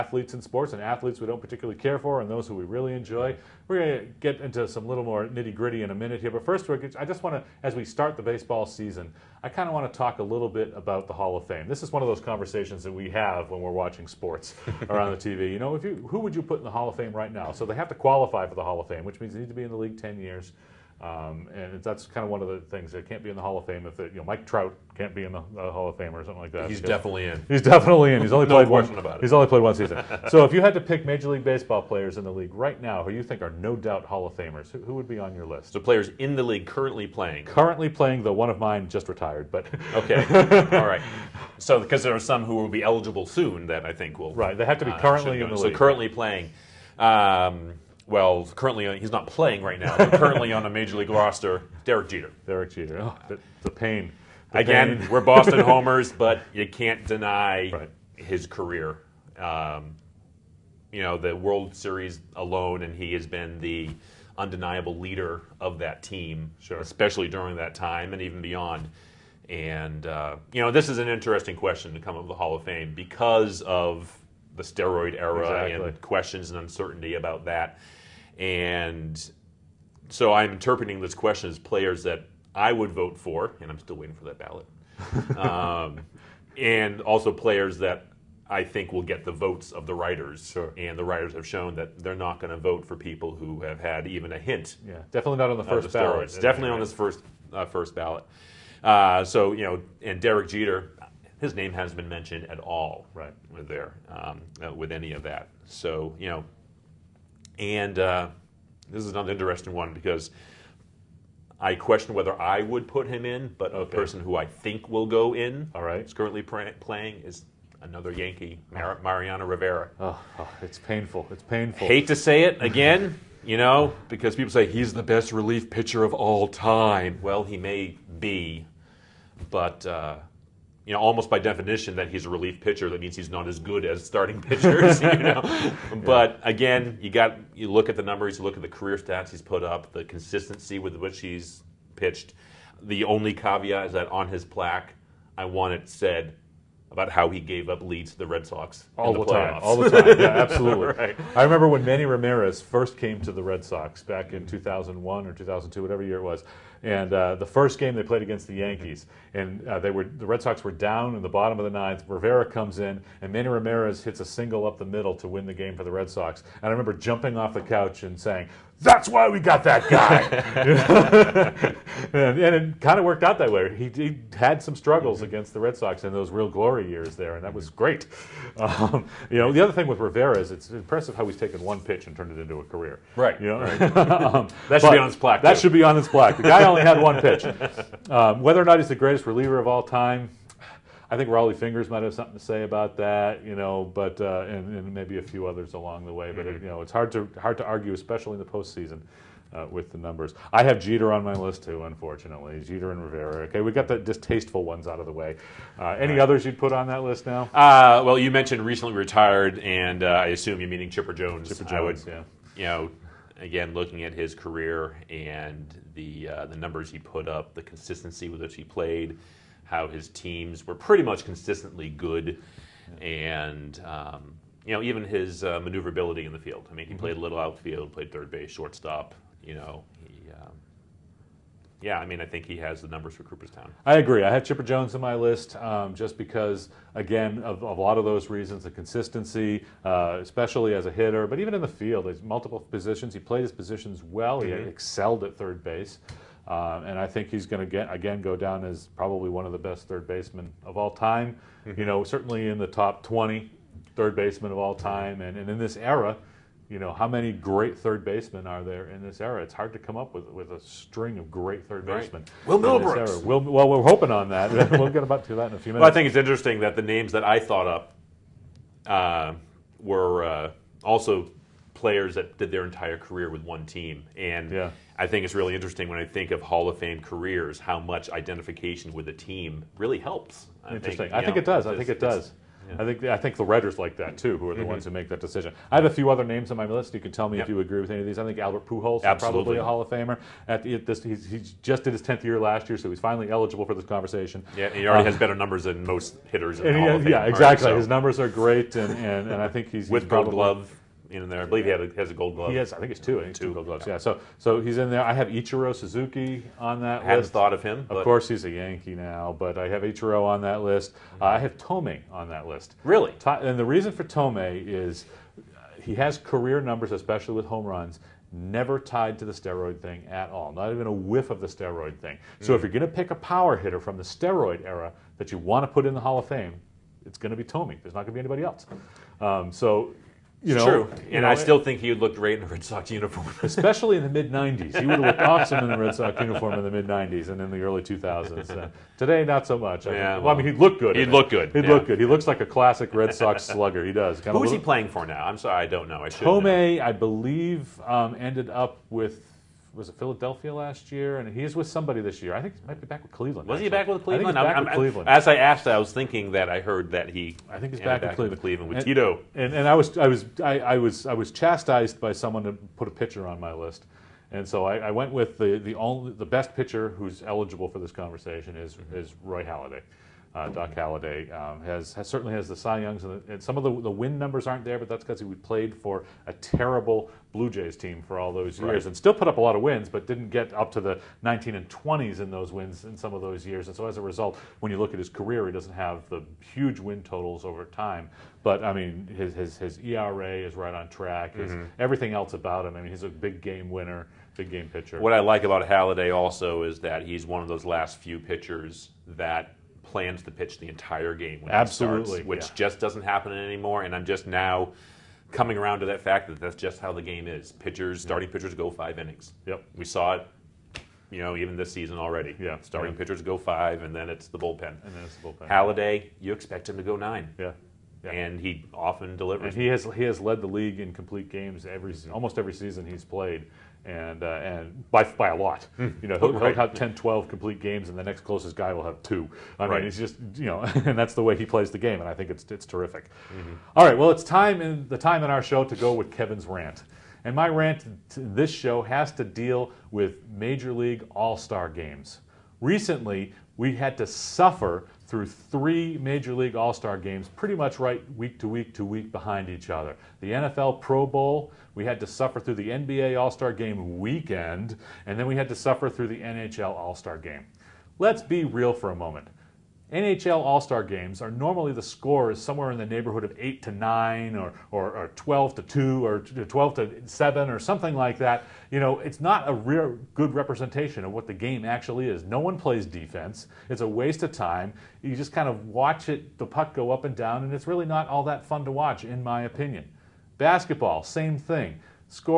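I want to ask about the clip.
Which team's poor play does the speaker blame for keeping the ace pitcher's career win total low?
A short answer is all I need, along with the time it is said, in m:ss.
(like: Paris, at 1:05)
Blue Jays, at 6:17.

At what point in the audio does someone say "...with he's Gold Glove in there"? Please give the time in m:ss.
4:59.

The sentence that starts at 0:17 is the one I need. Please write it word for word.
So they have to qualify for the Hall of Fame, which means they need to be in the league 10 years.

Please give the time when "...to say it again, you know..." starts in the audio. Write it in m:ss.
2:02.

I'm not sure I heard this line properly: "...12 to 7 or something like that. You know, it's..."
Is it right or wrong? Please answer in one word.
right.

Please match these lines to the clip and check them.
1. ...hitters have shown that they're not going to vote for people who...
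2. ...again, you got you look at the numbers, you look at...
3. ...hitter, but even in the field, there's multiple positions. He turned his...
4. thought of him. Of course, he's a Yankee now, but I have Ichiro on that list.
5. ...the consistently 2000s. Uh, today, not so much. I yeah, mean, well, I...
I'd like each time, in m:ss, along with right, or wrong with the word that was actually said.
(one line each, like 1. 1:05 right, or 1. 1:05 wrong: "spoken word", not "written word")
1. 1:31 wrong: "writers", not "hitters"
2. 2:16 right
3. 4:00 wrong: "played", not "turned"
4. 5:07 right
5. 5:37 wrong: "early", not "consistently".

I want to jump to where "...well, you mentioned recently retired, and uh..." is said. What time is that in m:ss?
3:28.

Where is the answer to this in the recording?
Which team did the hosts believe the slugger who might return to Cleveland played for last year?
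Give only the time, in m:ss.
5:49.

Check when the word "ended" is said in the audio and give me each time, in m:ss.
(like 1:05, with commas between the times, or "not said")
5:48.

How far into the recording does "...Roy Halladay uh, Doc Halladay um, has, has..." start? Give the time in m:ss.
6:09.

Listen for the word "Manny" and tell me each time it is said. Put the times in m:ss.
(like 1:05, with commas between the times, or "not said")
2:31, 2:43.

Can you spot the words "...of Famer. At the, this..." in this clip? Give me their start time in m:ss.
4:49.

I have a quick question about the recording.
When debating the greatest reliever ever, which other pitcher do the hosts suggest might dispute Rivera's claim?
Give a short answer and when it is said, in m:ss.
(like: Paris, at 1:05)
Rollie Fingers, at 3:11.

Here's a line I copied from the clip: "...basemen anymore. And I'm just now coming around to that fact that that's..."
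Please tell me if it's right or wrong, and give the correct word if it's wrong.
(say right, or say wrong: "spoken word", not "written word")
wrong: "happen", not "basemen".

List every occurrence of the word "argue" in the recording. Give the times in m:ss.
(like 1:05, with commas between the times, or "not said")
3:17.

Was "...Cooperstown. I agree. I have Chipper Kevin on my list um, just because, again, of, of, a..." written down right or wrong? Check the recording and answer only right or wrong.
wrong.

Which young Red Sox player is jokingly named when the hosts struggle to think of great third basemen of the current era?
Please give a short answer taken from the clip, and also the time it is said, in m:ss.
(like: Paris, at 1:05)
Will Middlebrooks, at 4:22.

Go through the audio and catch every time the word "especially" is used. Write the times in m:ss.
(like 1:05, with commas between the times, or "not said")
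1:06, 3:17, 4:00, 5:16, 5:33.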